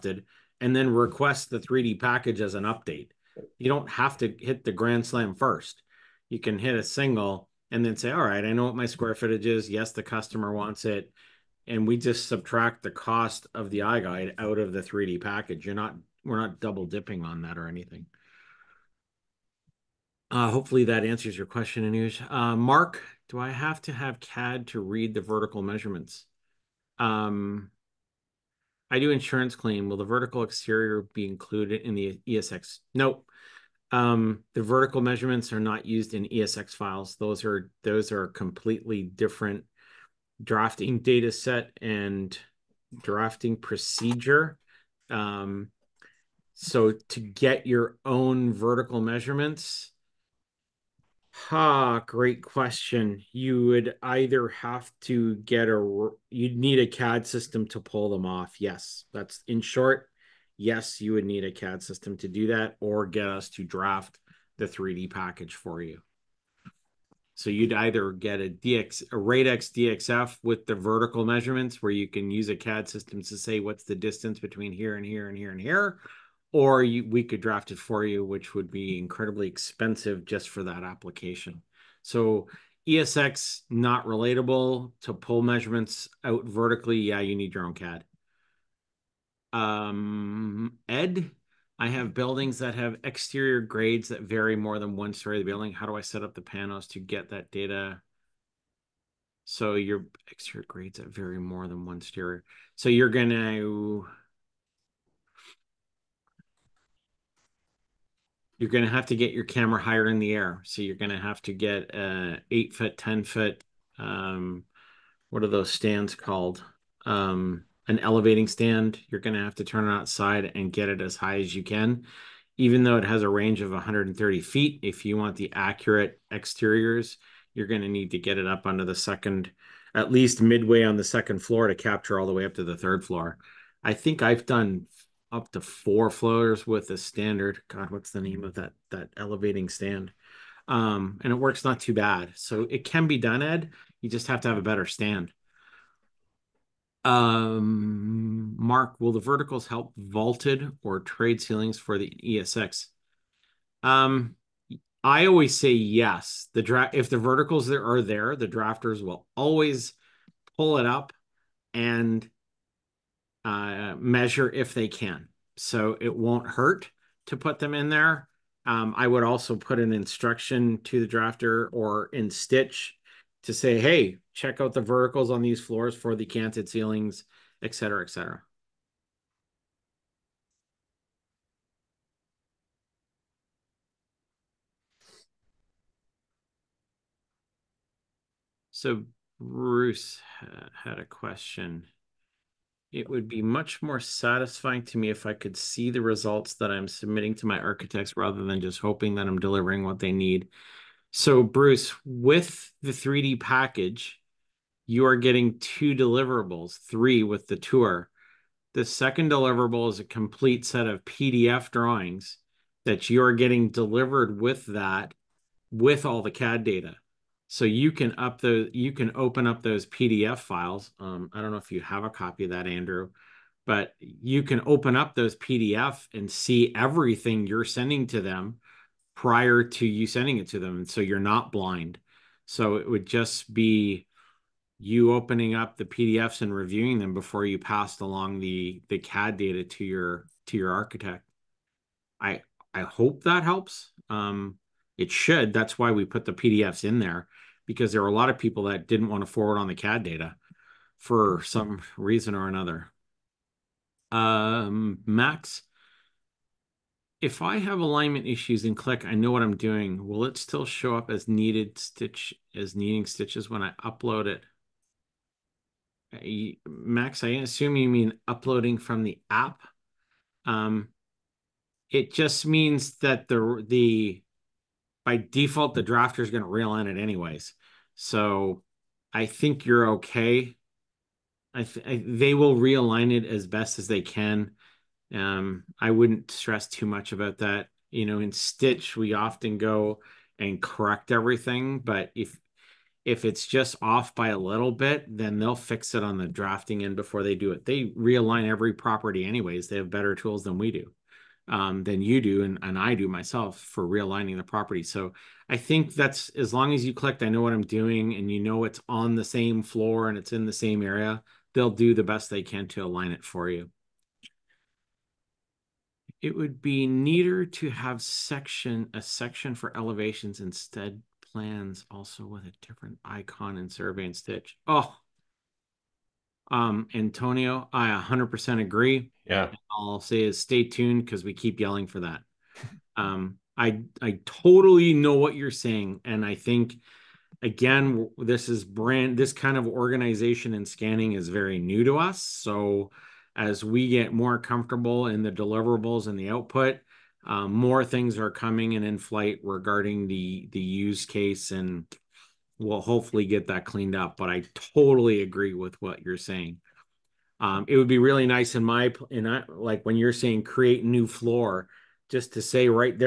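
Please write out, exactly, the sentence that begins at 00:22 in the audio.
Uh, Mark, do I have to have CAD to read the vertical measurements?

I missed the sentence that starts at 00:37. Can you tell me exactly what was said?
Those are those are completely different drafting data set and drafting procedure.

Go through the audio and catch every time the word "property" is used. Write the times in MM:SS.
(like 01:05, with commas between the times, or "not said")
04:58, 05:04.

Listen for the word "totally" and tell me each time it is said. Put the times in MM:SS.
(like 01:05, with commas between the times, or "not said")
05:34, 05:54.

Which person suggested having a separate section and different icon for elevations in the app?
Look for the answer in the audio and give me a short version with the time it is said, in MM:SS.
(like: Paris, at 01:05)
Antonio, at 05:26.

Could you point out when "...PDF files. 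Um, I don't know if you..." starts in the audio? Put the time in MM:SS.
03:39.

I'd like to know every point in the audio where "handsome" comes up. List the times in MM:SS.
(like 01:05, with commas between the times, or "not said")
not said.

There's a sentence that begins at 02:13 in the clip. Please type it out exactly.
I think I've done up to four floaters with a standard.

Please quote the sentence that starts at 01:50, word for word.
So you're going to have to get a uh, eight foot, 10 foot, um, what are those stands called?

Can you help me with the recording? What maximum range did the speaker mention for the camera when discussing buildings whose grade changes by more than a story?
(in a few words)
130 feet.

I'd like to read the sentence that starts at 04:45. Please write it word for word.
Um, I wouldn't stress too much about that.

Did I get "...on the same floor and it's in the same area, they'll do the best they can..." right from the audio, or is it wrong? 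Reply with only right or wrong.
right.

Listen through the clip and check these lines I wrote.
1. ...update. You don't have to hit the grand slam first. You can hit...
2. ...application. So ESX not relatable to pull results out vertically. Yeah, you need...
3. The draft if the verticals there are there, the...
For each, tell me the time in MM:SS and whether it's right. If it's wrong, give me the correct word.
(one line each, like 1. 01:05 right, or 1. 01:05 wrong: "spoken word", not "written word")
1. 00:02 right
2. 01:20 wrong: "measurements", not "results"
3. 02:36 right.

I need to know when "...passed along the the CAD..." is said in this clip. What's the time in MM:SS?
03:57.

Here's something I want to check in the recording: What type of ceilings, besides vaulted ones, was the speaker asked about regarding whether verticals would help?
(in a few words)
tray ceilings.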